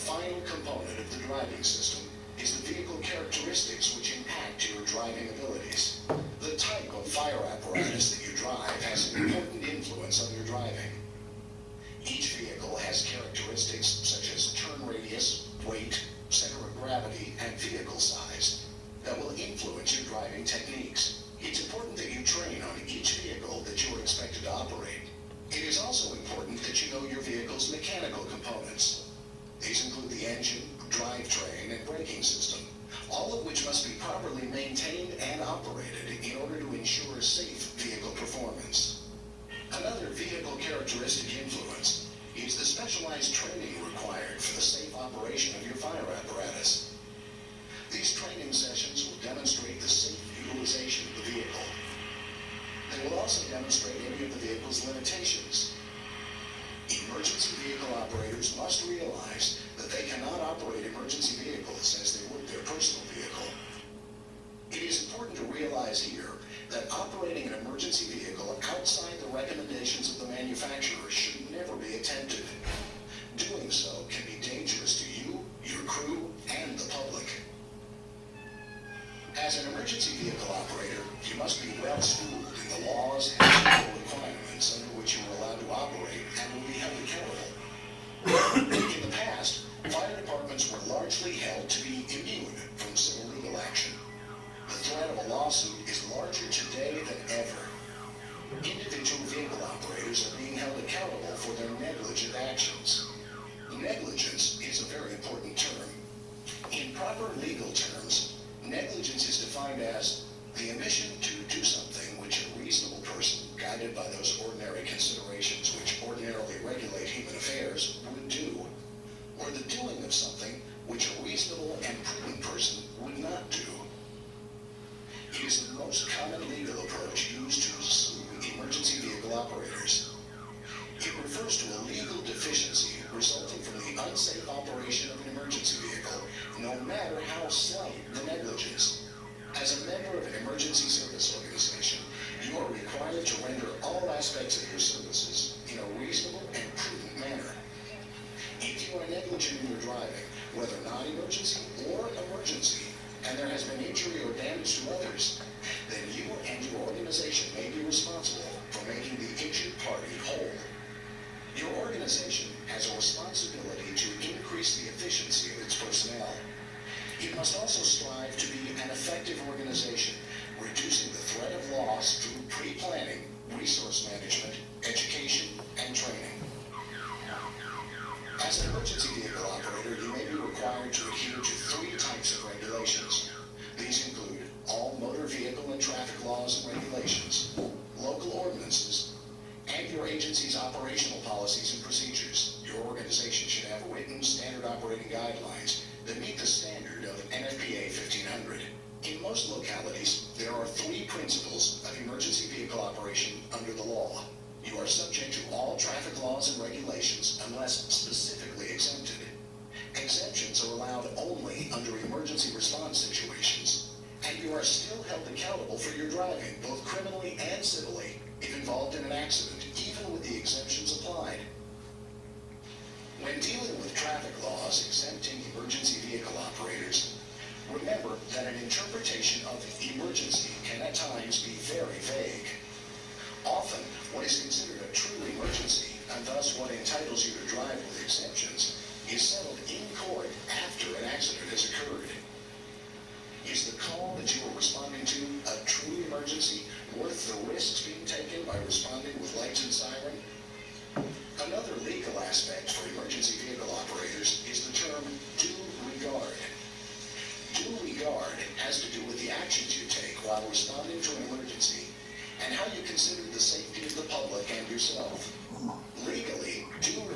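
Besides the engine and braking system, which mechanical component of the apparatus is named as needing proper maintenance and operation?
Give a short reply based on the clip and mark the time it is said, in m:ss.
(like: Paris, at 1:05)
drivetrain, at 0:30.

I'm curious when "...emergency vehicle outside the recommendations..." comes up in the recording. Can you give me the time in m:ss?
1:07.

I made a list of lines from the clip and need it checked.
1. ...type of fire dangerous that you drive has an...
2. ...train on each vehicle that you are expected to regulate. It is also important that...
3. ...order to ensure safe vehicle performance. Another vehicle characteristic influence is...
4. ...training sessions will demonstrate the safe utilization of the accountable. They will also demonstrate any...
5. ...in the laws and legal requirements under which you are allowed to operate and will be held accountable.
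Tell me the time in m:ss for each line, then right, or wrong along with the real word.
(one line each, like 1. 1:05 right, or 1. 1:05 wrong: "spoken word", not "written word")
1. 0:06 wrong: "apparatus", not "dangerous"
2. 0:22 wrong: "operate", not "regulate"
3. 0:36 right
4. 0:48 wrong: "vehicle", not "accountable"
5. 1:22 right.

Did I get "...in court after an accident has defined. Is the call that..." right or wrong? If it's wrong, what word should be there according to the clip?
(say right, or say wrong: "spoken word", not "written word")
wrong: "occurred", not "defined".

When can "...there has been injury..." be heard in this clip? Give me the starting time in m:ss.
2:33.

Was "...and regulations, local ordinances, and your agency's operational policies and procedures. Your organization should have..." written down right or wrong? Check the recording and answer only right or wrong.
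right.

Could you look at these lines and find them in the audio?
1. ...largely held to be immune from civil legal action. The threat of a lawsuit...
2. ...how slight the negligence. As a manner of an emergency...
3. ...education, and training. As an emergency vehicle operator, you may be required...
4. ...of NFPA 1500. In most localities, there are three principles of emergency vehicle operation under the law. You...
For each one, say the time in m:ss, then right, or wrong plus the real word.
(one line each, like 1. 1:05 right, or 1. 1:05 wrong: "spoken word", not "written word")
1. 1:30 right
2. 2:17 wrong: "member", not "manner"
3. 2:54 right
4. 3:17 right.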